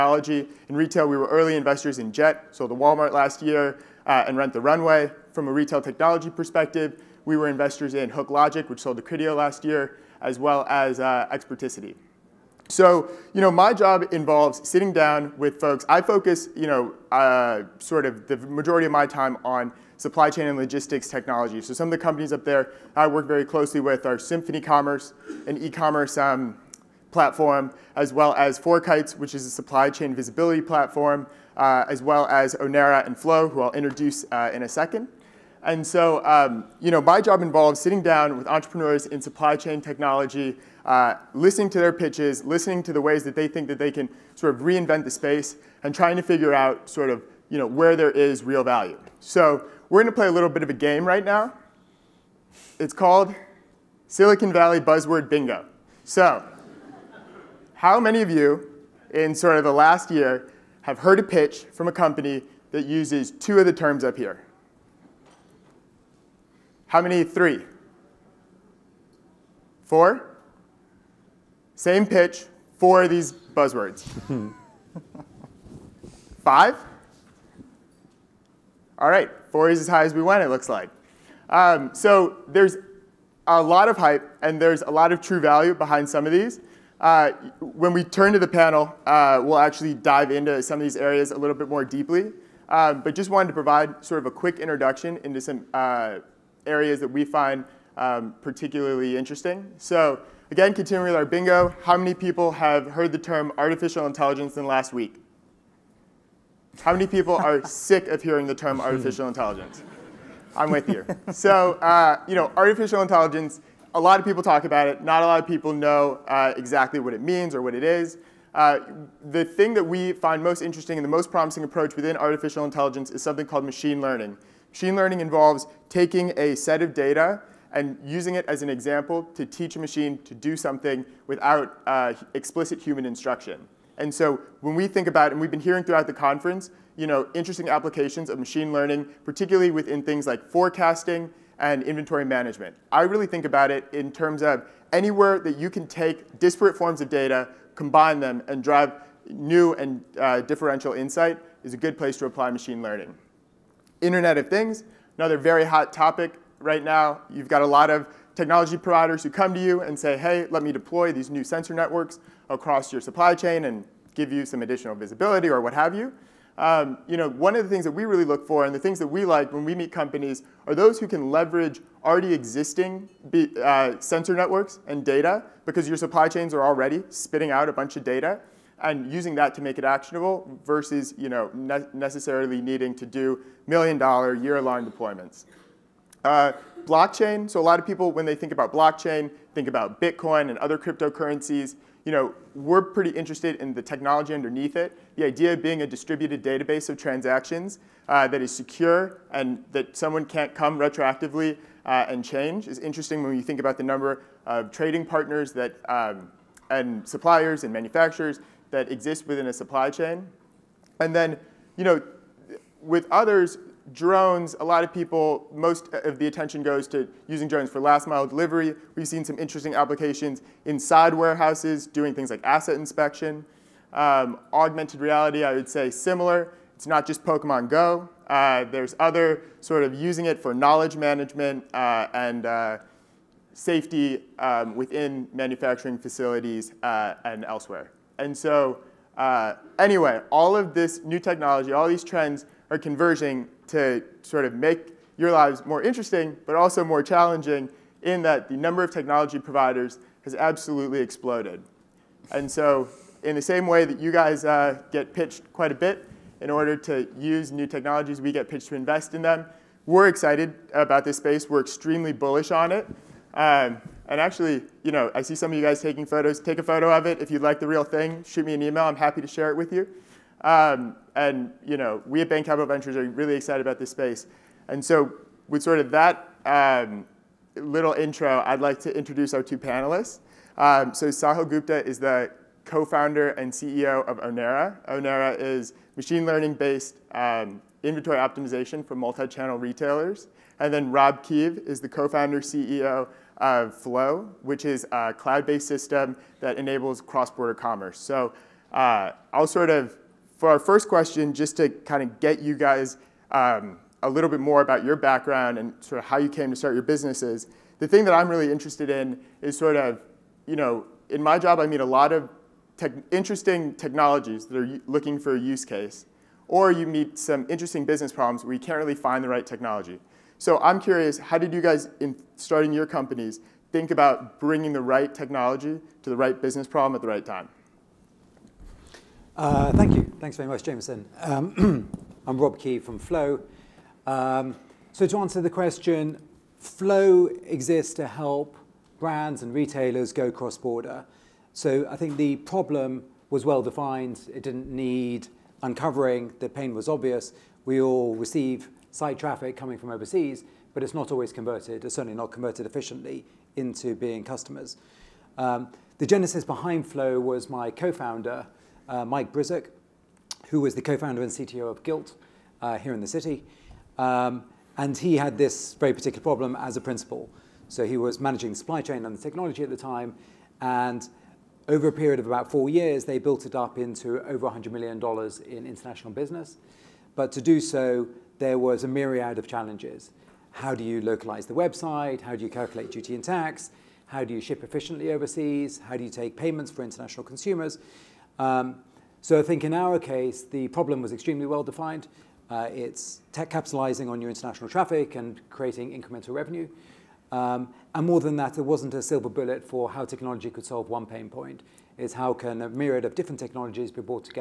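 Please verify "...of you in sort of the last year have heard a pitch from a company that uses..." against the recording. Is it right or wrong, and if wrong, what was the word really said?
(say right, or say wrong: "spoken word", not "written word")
right.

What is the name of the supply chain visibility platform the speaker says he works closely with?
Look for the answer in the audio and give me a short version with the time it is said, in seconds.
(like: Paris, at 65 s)
FourKites, at 28 s.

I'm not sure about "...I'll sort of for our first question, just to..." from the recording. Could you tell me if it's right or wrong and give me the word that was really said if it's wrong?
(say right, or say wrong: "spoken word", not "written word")
right.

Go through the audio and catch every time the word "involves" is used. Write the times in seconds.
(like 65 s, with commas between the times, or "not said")
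14 s, 37 s, 125 s.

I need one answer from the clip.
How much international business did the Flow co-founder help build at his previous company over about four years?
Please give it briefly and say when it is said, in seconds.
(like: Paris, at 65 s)
Over $100 million, at 374 s.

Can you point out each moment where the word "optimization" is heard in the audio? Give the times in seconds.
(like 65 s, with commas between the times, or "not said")
288 s.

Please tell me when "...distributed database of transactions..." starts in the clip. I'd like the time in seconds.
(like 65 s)
195 s.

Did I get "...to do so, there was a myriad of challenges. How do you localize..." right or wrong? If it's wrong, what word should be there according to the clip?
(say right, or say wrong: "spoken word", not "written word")
right.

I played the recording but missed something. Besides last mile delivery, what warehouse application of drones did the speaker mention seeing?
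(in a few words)
Asset inspection.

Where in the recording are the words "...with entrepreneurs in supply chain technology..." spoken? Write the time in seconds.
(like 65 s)
38 s.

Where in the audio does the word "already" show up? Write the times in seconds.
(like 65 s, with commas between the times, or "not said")
172 s, 176 s.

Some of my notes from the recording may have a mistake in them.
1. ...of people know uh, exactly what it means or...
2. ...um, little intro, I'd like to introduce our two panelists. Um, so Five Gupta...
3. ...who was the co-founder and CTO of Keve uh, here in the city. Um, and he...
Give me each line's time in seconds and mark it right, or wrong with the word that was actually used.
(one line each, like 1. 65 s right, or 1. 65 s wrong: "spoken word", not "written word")
1. 115 s right
2. 276 s wrong: "Sahil", not "Five"
3. 360 s wrong: "Gilt", not "Keve".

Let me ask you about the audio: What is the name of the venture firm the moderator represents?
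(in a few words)
Bain Capital Ventures.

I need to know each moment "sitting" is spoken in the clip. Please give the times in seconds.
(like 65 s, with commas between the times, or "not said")
14 s, 37 s.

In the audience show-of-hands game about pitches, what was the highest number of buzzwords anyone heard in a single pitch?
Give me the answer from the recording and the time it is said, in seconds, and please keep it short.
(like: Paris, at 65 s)
4, at 79 s.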